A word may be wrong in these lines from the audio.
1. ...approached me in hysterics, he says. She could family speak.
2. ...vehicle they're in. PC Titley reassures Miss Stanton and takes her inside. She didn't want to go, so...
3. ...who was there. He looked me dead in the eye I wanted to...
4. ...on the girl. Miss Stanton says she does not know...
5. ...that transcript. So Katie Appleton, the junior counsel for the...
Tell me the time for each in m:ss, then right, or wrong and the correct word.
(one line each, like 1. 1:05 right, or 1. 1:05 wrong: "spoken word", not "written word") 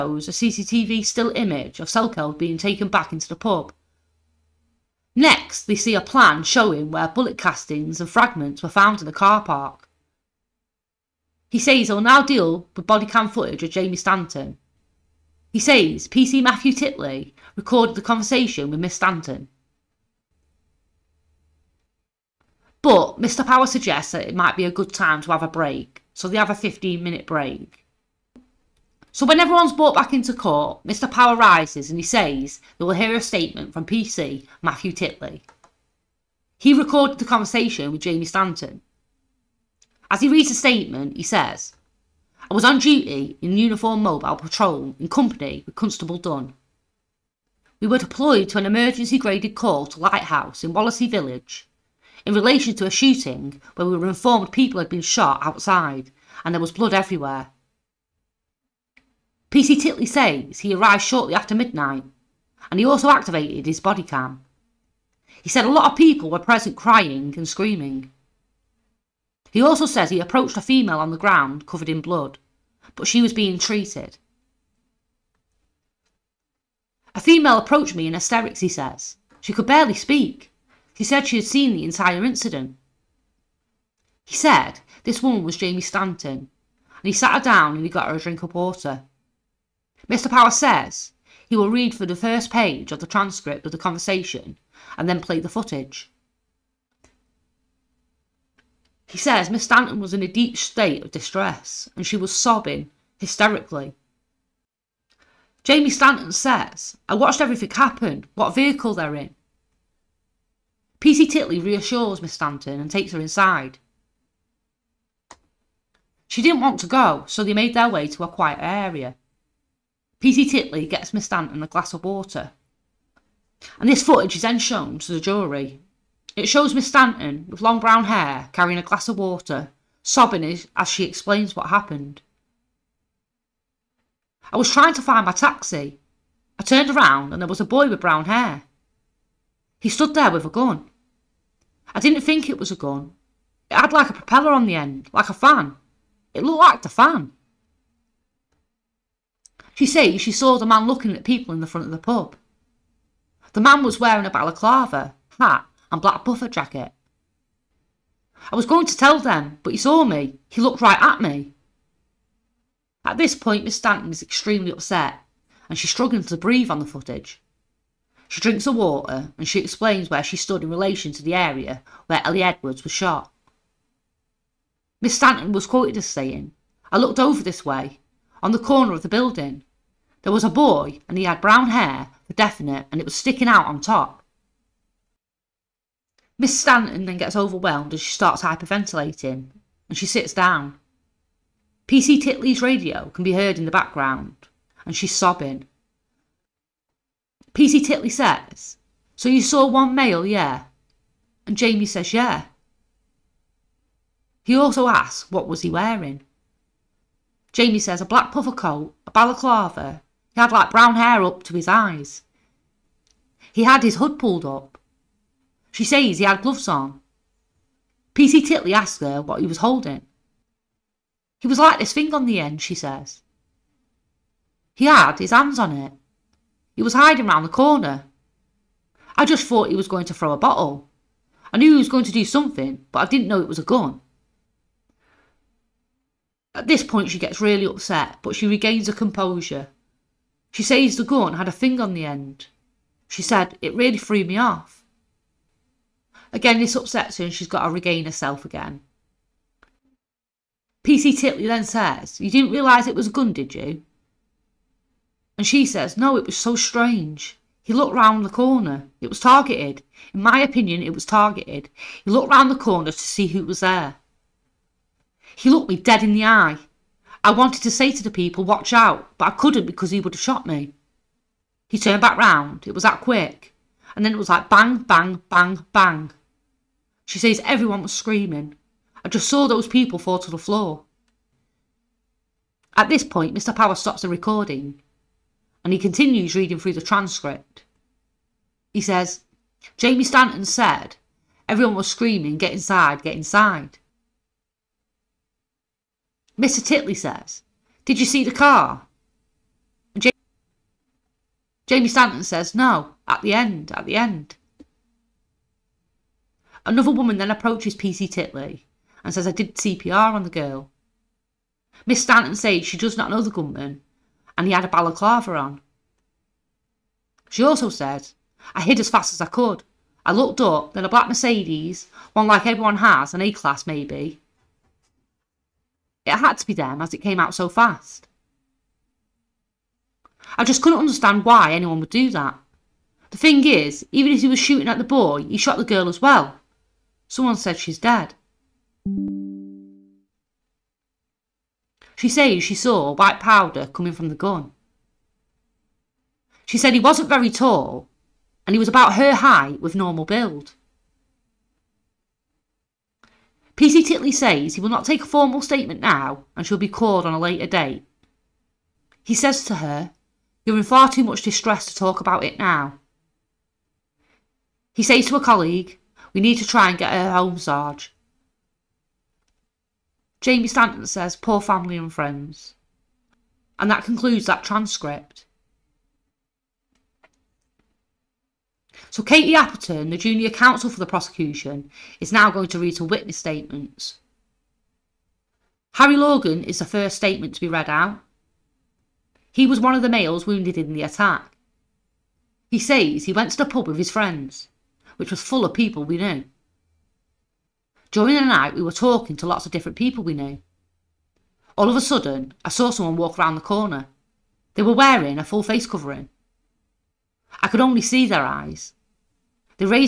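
1. 1:17 wrong: "barely", not "family"
2. 1:48 right
3. 4:23 right
4. 5:10 right
5. 6:14 right.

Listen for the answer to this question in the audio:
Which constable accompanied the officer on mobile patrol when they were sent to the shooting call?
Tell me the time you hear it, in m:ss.
0:45.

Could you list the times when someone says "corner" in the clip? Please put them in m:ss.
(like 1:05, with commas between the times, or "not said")
2:58, 3:47, 4:18, 4:22, 6:43.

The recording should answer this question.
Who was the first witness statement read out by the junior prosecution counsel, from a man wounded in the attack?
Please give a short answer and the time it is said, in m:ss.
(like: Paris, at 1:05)
Harry Logan, at 6:25.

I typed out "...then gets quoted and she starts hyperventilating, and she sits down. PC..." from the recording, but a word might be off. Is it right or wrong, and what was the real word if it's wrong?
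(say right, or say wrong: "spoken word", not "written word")
wrong: "overwhelmed", not "quoted".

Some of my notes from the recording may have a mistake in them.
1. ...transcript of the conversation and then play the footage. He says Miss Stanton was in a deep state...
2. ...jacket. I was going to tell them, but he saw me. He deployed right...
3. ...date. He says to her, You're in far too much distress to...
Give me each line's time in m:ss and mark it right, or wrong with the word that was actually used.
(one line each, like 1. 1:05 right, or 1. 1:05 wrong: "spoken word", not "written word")
1. 1:33 right
2. 2:36 wrong: "looked", not "deployed"
3. 5:57 right.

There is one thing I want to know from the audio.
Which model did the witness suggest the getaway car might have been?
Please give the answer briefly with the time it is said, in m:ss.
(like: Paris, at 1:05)
A-class, at 5:23.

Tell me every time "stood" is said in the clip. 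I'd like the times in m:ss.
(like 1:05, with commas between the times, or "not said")
2:19, 2:50.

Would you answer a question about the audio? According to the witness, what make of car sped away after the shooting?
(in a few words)
Mercedes.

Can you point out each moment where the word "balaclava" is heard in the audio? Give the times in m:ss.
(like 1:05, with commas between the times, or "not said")
2:34, 3:29, 5:14.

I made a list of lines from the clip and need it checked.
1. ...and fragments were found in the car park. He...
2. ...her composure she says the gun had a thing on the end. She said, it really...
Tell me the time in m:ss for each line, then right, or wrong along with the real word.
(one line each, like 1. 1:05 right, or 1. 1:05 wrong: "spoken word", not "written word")
1. 0:08 right
2. 3:58 right.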